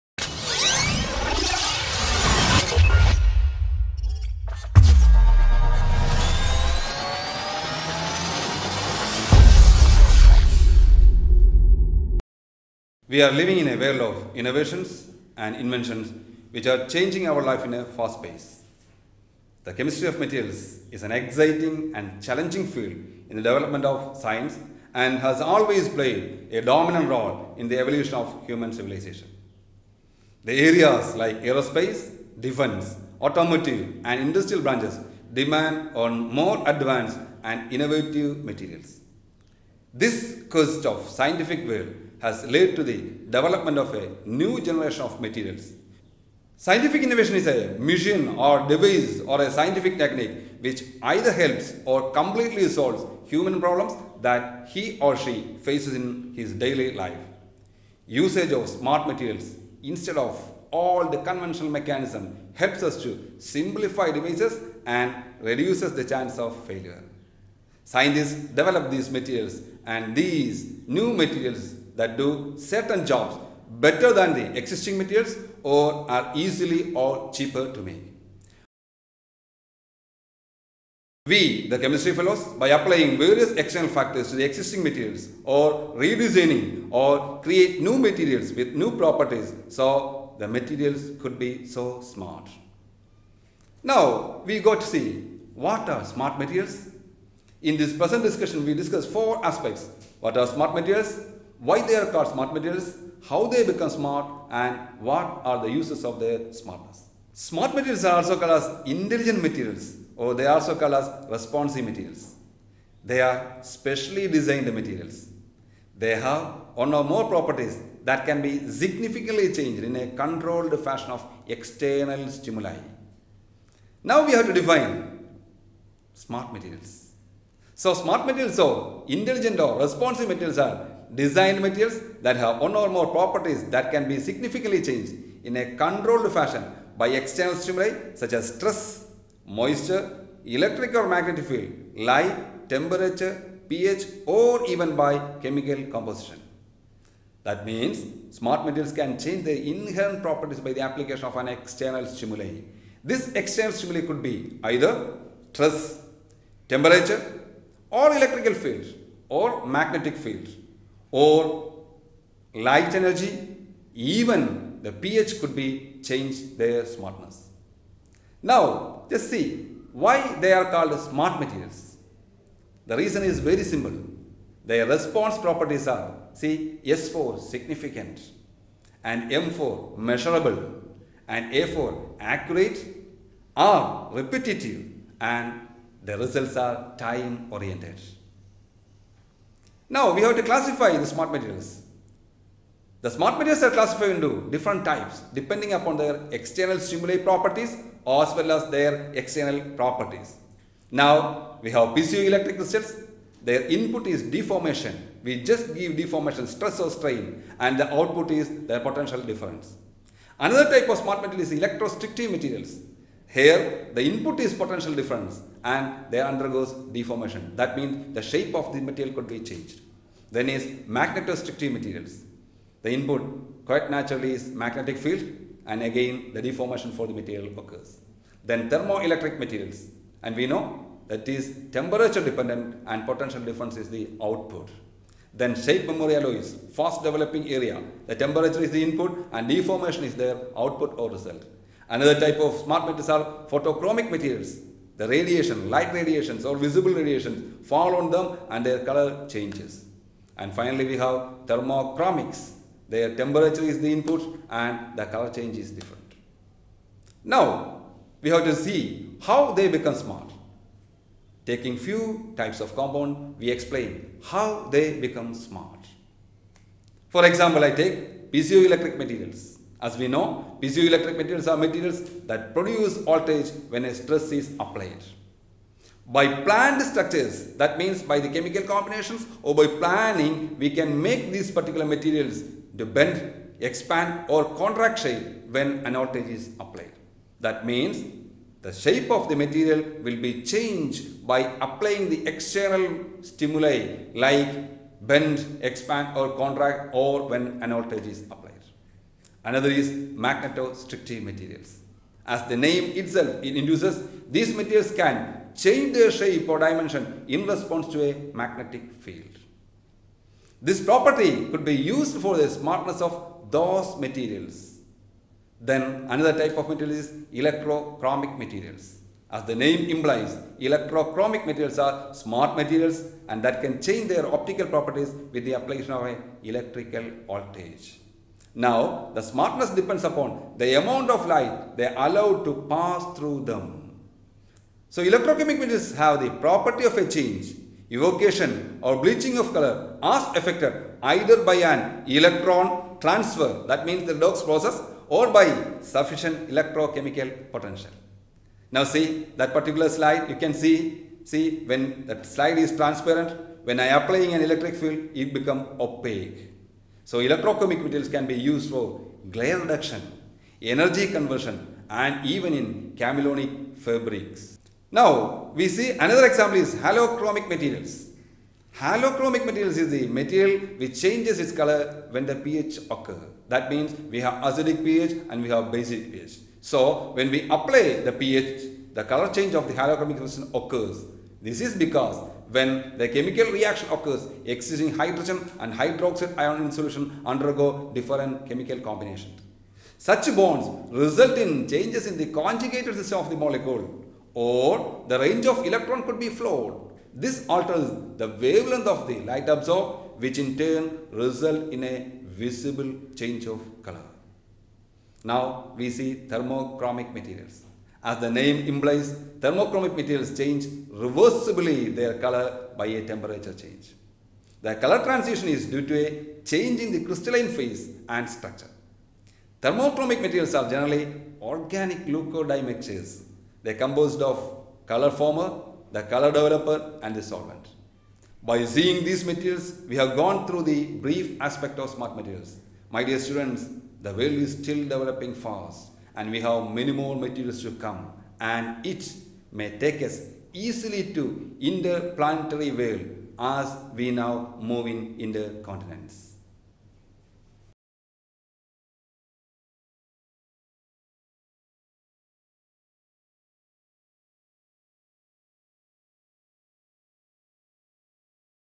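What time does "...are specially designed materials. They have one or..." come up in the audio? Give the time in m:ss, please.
1:53.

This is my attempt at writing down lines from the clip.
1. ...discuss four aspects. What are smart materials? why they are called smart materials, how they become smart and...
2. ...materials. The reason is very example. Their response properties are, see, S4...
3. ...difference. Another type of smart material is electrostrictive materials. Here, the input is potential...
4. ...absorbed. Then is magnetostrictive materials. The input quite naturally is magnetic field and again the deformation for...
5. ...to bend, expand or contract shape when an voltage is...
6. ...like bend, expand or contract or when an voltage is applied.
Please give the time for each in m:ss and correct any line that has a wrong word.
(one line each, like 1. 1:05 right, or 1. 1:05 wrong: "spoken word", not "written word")
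1. 1:38 right
2. 2:51 wrong: "simple", not "example"
3. 3:29 right
4. 3:39 wrong: "changed", not "absorbed"
5. 4:42 right
6. 4:54 right.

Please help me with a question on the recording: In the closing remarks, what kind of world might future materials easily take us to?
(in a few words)
interplanetary world.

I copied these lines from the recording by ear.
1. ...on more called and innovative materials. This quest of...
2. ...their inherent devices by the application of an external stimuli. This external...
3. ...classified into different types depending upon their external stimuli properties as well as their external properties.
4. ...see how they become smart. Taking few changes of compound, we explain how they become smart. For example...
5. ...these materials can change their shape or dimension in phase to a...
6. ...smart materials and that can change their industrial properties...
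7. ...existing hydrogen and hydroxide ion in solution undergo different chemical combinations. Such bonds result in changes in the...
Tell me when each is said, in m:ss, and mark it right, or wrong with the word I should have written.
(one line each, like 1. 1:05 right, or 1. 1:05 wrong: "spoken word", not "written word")
1. 0:35 wrong: "advanced", not "called"
2. 2:29 wrong: "properties", not "devices"
3. 3:13 right
4. 4:18 wrong: "types", not "changes"
5. 5:04 wrong: "response", not "phase"
6. 5:22 wrong: "optical", not "industrial"
7. 6:24 right.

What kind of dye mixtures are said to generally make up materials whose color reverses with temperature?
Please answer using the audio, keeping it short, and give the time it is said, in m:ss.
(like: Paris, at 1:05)
organic leuco dye, at 7:01.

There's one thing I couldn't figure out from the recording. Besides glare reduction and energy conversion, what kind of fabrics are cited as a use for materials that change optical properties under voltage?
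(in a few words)
chameleonic fabrics.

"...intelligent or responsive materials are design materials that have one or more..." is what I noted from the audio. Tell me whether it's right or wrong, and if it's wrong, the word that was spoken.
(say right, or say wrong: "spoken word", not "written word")
right.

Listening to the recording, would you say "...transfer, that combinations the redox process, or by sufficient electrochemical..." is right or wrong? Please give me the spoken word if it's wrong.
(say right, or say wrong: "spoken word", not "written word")
wrong: "means", not "combinations".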